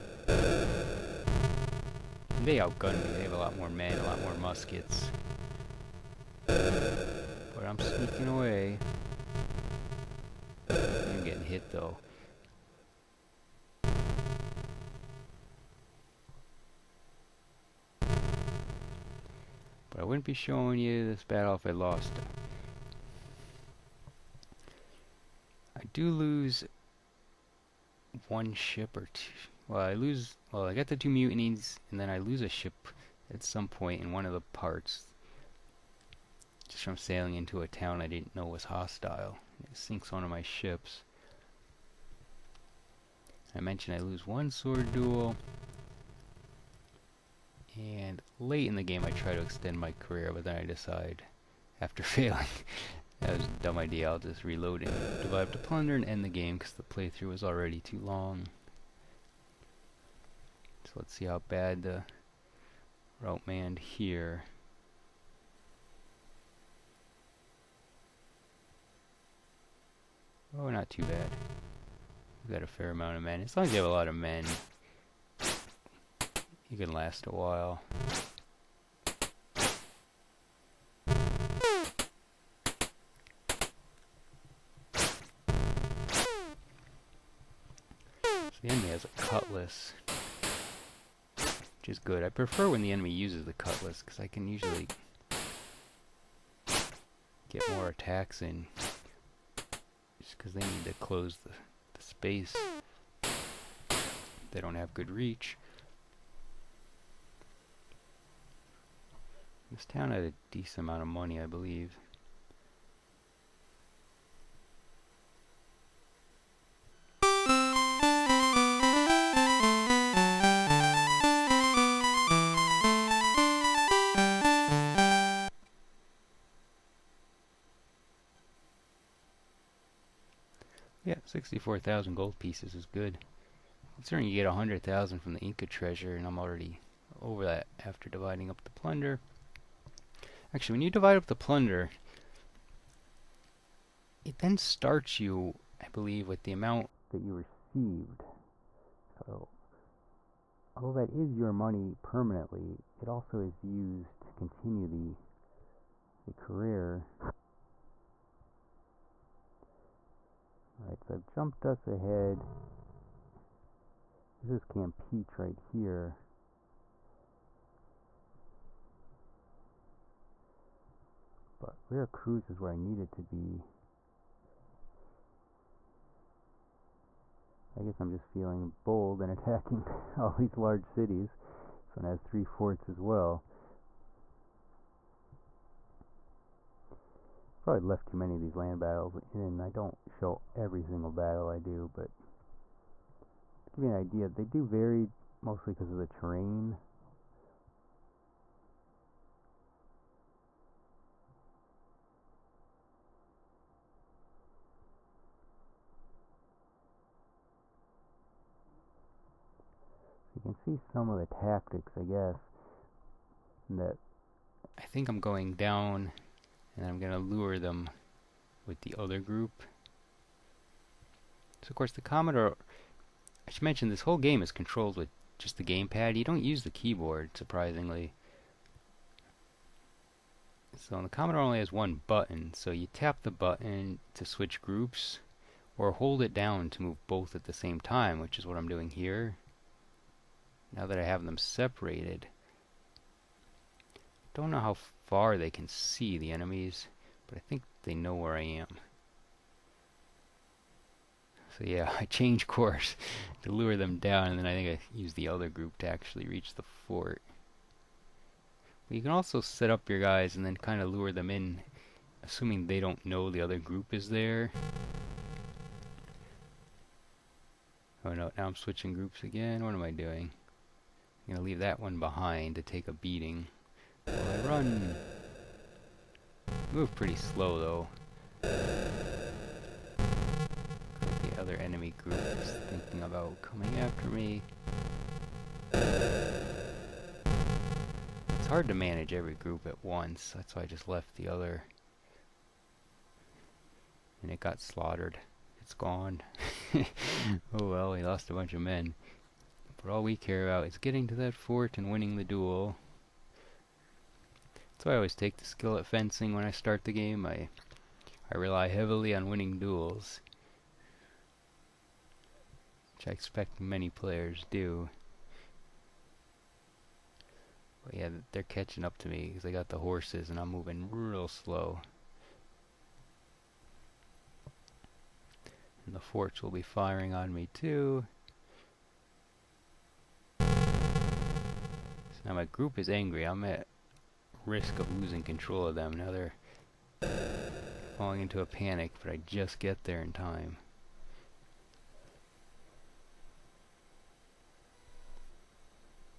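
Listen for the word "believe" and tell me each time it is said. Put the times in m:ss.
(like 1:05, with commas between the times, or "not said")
1:51, 2:25.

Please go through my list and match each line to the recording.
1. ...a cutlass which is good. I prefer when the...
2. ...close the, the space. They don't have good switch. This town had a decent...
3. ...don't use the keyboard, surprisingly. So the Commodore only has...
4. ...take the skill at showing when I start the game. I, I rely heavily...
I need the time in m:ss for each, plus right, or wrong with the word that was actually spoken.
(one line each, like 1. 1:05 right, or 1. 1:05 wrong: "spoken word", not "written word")
1. 1:29 right
2. 1:40 wrong: "reach", not "switch"
3. 3:46 right
4. 5:05 wrong: "fencing", not "showing".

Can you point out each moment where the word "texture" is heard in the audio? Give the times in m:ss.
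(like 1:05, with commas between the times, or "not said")
not said.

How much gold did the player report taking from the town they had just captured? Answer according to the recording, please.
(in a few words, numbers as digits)
64,000 gold pieces.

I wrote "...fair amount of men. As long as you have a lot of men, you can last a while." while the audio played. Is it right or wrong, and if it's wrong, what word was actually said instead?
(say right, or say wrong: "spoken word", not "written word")
right.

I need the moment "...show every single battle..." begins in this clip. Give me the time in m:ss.
3:10.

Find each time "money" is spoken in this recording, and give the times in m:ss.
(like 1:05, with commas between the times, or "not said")
1:51, 2:31.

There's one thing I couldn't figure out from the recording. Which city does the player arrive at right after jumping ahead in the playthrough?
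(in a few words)
Campeche.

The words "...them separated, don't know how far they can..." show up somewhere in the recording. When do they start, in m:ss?
4:01.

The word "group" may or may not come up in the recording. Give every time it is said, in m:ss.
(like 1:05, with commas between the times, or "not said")
3:39, 3:54, 4:15, 4:23, 4:28, 4:42, 4:49, 5:32.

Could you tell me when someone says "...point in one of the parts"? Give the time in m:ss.
0:33.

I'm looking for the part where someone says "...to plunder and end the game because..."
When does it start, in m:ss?
0:55.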